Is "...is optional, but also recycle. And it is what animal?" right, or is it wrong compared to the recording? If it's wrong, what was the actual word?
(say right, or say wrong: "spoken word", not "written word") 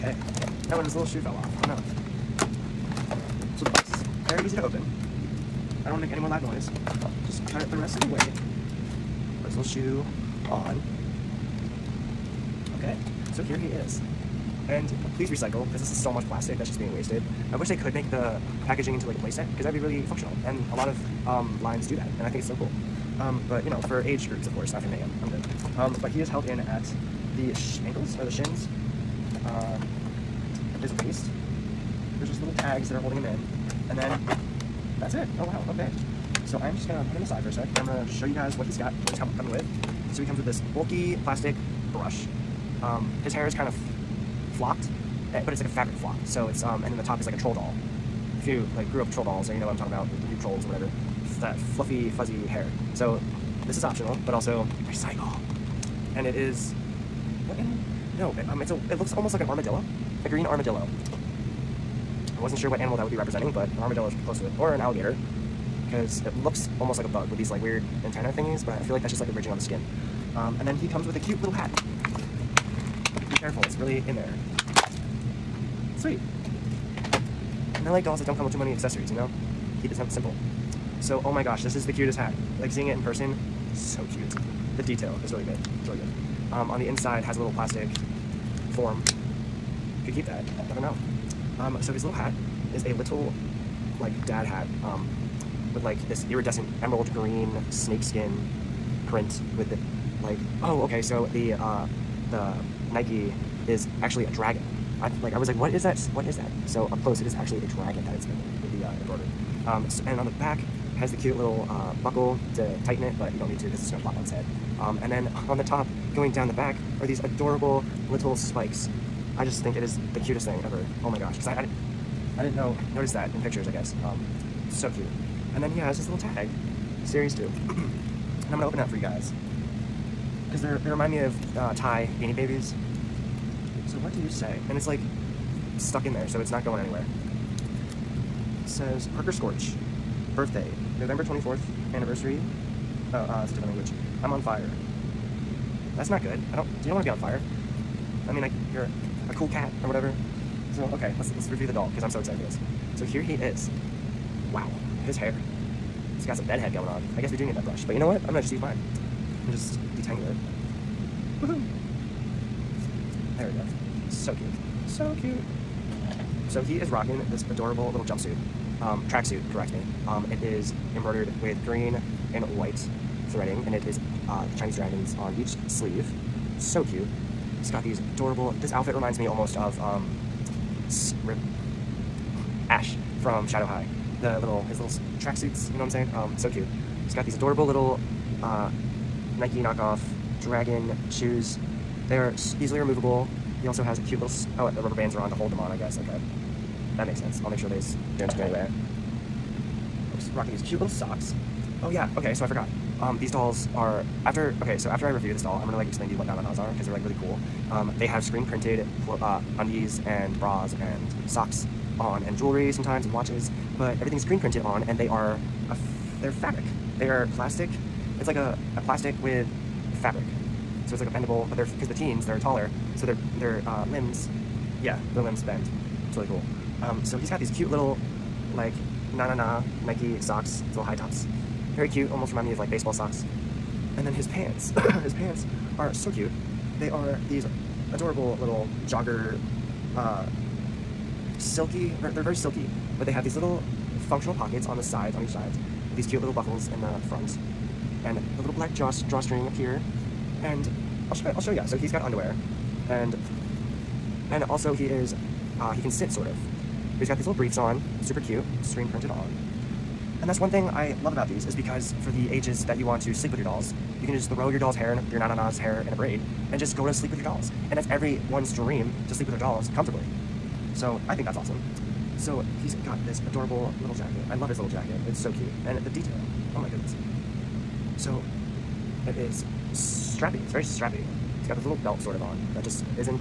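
right.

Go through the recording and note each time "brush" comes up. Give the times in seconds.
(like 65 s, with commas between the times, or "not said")
41 s, 157 s.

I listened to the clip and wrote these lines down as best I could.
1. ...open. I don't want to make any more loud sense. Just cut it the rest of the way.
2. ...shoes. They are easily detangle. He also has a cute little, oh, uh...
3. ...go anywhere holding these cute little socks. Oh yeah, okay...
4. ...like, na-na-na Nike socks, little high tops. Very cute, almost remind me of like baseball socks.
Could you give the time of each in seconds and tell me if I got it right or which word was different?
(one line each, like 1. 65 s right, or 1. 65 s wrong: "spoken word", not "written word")
1. 4 s wrong: "noise", not "sense"
2. 191 s wrong: "removable", not "detangle"
3. 198 s wrong: "rocking", not "holding"
4. 228 s right.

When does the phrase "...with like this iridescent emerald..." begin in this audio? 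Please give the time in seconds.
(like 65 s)
95 s.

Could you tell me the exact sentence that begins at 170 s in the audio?
Um, it is embroidered with green and white threading, and it is uh, Chinese dragons on each sleeve.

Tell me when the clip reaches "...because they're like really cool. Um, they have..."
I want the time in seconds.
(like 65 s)
206 s.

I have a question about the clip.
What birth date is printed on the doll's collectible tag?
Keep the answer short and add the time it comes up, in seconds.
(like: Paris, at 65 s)
November 24th, at 140 s.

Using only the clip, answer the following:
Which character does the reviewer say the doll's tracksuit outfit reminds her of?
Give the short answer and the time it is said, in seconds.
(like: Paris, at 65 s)
Ash, at 182 s.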